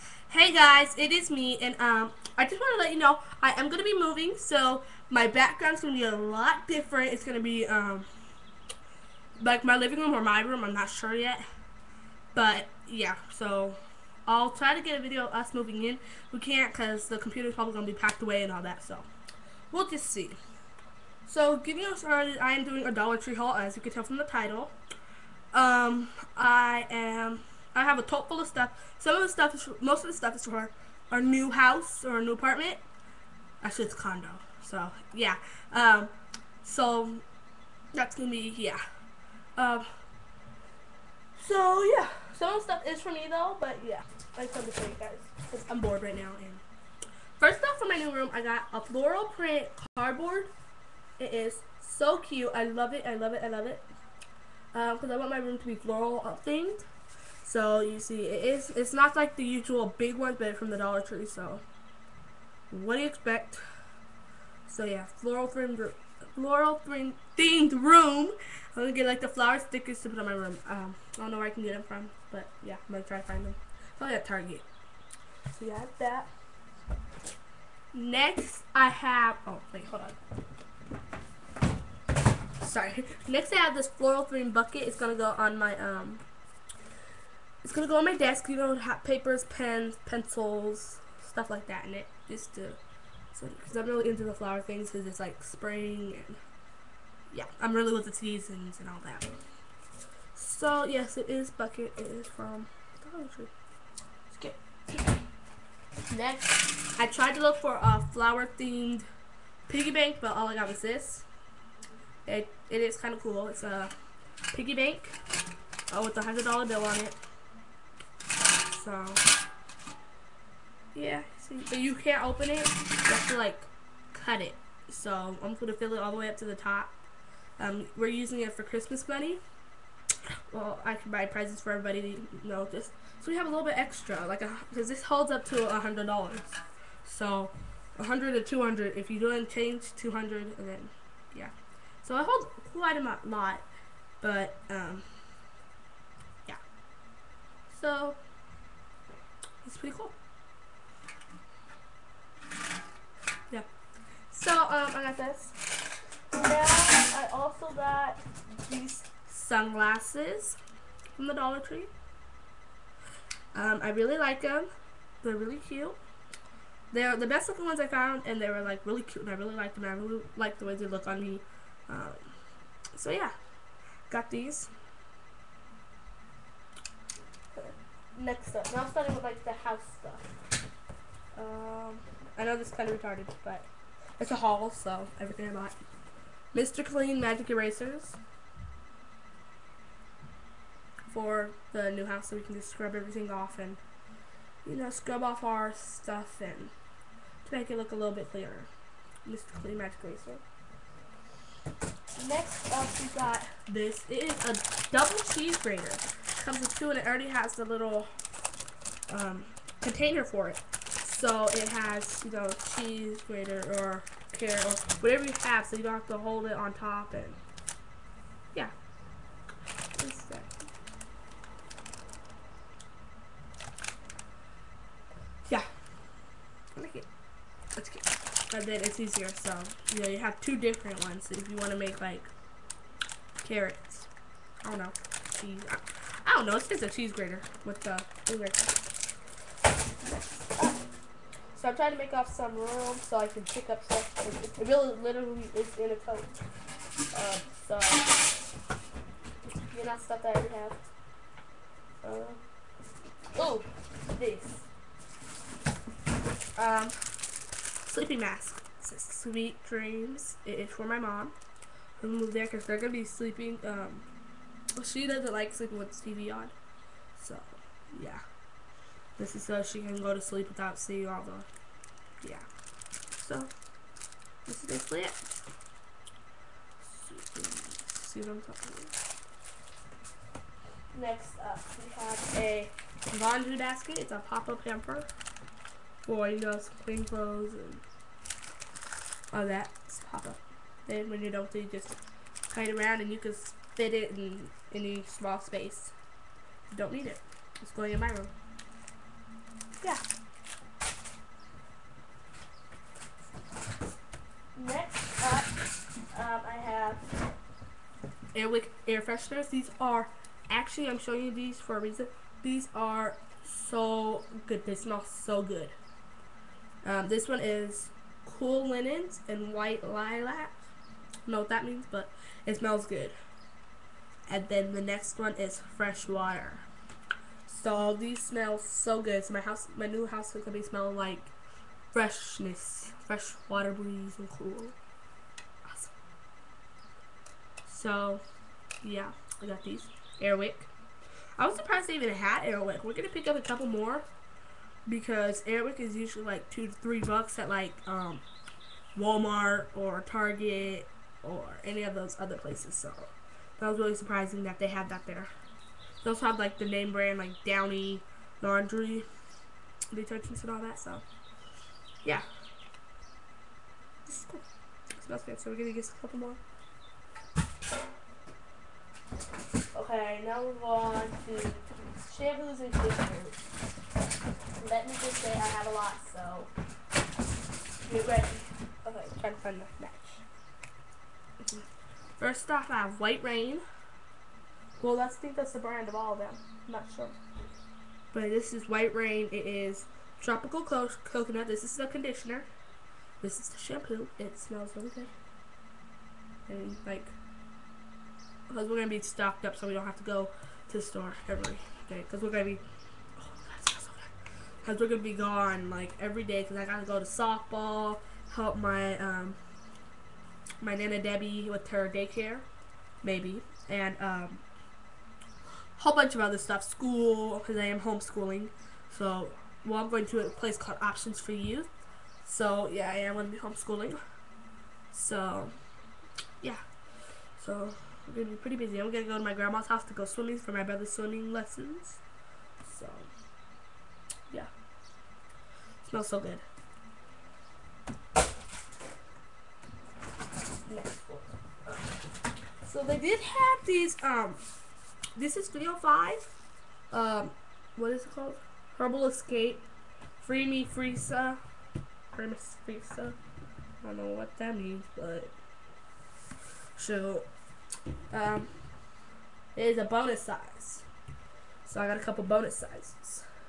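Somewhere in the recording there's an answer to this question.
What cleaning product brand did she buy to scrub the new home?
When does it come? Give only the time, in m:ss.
3:19.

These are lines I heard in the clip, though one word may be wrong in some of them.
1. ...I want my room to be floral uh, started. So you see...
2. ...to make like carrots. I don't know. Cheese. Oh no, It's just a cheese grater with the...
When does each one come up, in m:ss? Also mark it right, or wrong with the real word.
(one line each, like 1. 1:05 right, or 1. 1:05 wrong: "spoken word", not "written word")
1. 0:55 wrong: "themed", not "started"
2. 3:51 right.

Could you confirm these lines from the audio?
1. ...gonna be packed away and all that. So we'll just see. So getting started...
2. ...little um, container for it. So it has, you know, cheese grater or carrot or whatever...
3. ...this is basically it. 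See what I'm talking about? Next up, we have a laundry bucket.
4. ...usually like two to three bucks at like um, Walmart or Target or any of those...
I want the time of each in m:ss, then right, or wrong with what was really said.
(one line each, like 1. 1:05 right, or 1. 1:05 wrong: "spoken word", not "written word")
1. 0:17 right
2. 3:27 right
3. 4:34 wrong: "basket", not "bucket"
4. 5:45 right.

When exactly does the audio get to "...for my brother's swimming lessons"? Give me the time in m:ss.
7:10.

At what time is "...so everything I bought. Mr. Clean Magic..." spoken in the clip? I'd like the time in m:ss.
3:04.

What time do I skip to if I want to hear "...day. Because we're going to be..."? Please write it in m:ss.
6:41.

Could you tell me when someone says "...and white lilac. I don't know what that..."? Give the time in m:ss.
5:19.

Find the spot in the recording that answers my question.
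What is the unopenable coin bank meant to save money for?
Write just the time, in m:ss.
2:08.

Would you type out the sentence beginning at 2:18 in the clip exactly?
If you don't change, two hundred, and then yeah.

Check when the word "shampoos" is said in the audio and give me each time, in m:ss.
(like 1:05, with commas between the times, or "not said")
6:12, 6:33.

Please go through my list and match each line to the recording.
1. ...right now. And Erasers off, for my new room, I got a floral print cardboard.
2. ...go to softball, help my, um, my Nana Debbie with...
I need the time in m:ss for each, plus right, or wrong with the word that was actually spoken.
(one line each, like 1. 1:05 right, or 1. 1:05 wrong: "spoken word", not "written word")
1. 0:46 wrong: "First", not "Erasers"
2. 6:46 right.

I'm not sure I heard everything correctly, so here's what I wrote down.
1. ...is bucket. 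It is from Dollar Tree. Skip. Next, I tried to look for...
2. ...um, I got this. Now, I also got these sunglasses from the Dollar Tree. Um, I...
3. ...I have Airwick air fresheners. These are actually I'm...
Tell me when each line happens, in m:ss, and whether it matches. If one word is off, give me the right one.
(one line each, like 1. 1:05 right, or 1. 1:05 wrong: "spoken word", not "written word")
1. 1:41 right
2. 2:34 right
3. 5:06 right.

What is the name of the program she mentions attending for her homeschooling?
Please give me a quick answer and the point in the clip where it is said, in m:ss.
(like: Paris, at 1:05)
Options for Youth, at 7:00.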